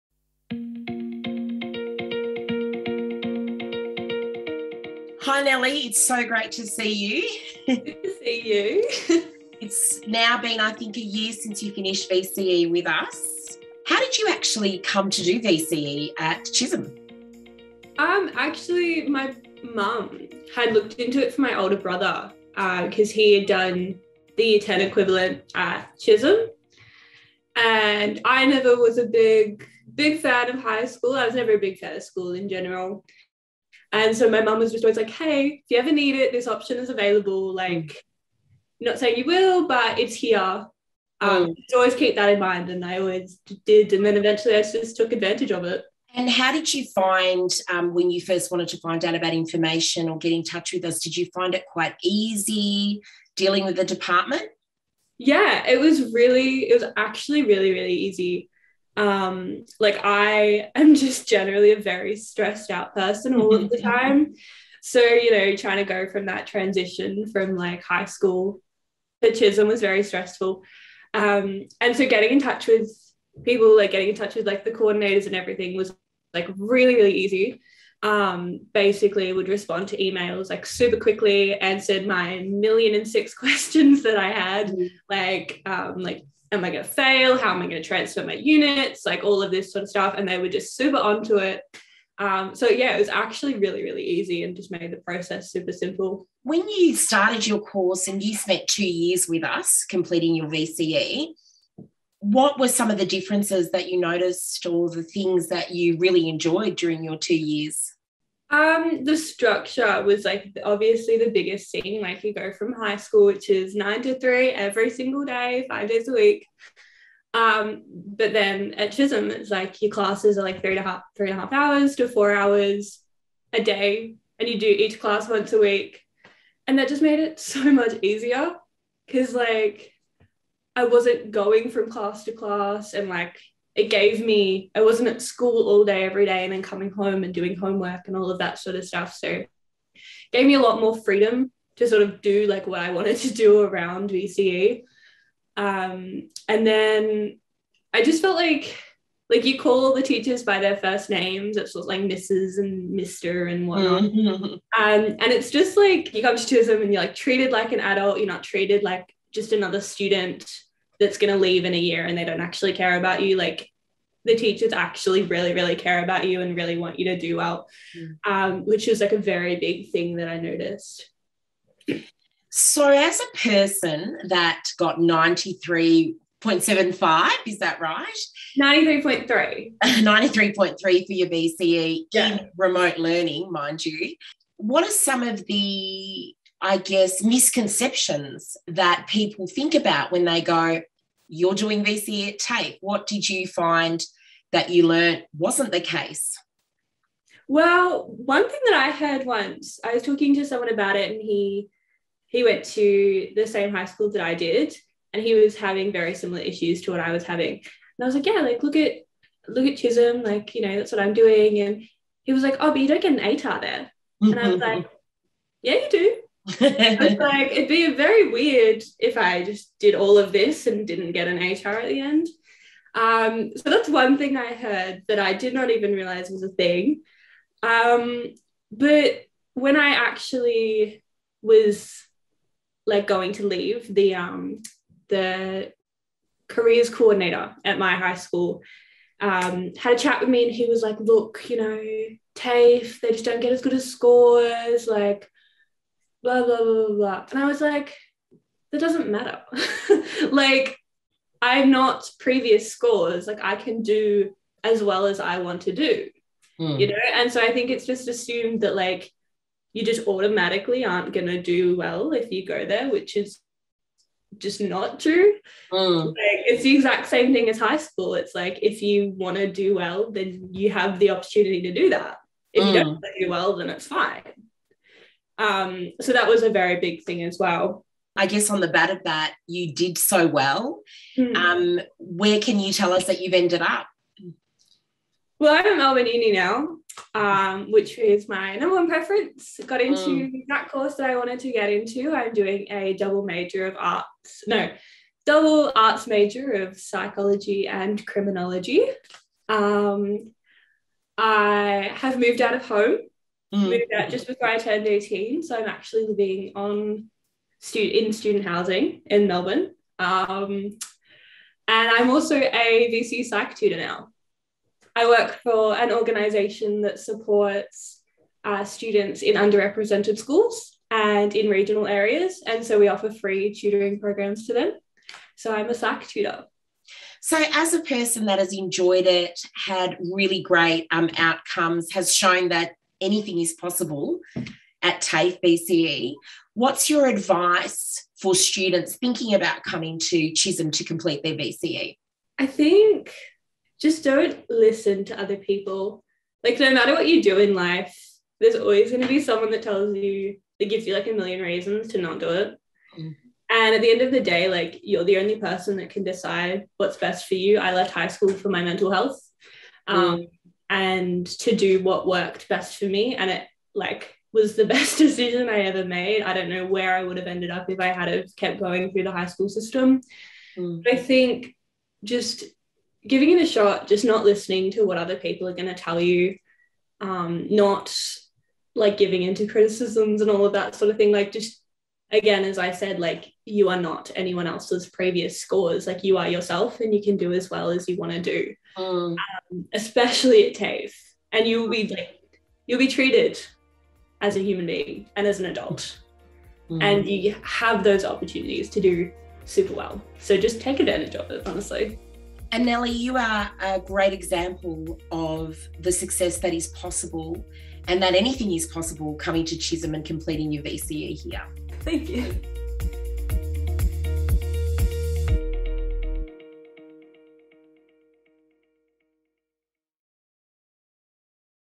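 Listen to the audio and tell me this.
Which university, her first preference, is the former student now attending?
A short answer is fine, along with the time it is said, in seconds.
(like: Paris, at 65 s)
Melbourne Uni, at 285 s.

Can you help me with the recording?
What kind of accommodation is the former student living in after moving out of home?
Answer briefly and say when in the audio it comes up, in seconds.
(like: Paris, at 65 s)
Student housing, at 308 s.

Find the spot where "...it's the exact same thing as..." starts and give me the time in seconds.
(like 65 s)
266 s.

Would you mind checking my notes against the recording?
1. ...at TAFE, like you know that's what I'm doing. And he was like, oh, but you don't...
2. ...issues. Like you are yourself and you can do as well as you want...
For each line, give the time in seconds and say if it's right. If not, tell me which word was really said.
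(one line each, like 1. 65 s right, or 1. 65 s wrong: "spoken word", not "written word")
1. 209 s wrong: "Chisholm", not "TAFE"
2. 385 s wrong: "scores", not "issues".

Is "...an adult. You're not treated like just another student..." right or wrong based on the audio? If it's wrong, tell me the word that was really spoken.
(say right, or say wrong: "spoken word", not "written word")
right.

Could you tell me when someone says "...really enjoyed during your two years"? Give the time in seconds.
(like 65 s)
105 s.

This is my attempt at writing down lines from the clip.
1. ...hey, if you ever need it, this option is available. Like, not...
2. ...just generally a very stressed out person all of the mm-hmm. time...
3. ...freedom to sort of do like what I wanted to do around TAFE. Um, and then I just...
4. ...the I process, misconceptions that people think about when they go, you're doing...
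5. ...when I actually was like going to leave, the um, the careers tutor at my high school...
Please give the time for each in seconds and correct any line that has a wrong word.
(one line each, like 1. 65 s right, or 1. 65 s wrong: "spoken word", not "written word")
1. 35 s right
2. 60 s right
3. 140 s wrong: "VCE", not "TAFE"
4. 185 s wrong: "guess", not "process"
5. 229 s wrong: "coordinator", not "tutor".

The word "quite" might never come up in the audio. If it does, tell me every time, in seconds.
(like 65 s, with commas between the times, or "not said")
51 s.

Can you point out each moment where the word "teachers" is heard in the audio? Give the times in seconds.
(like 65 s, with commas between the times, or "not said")
150 s, 164 s.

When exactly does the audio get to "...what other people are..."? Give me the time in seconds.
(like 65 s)
374 s.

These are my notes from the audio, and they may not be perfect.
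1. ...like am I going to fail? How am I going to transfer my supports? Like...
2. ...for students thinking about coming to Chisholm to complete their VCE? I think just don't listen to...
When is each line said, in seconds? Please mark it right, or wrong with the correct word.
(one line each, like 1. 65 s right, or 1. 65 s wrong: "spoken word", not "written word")
1. 85 s wrong: "units", not "supports"
2. 338 s right.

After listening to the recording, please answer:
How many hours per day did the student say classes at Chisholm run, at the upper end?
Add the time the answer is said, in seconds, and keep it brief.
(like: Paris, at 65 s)
4 hours, at 122 s.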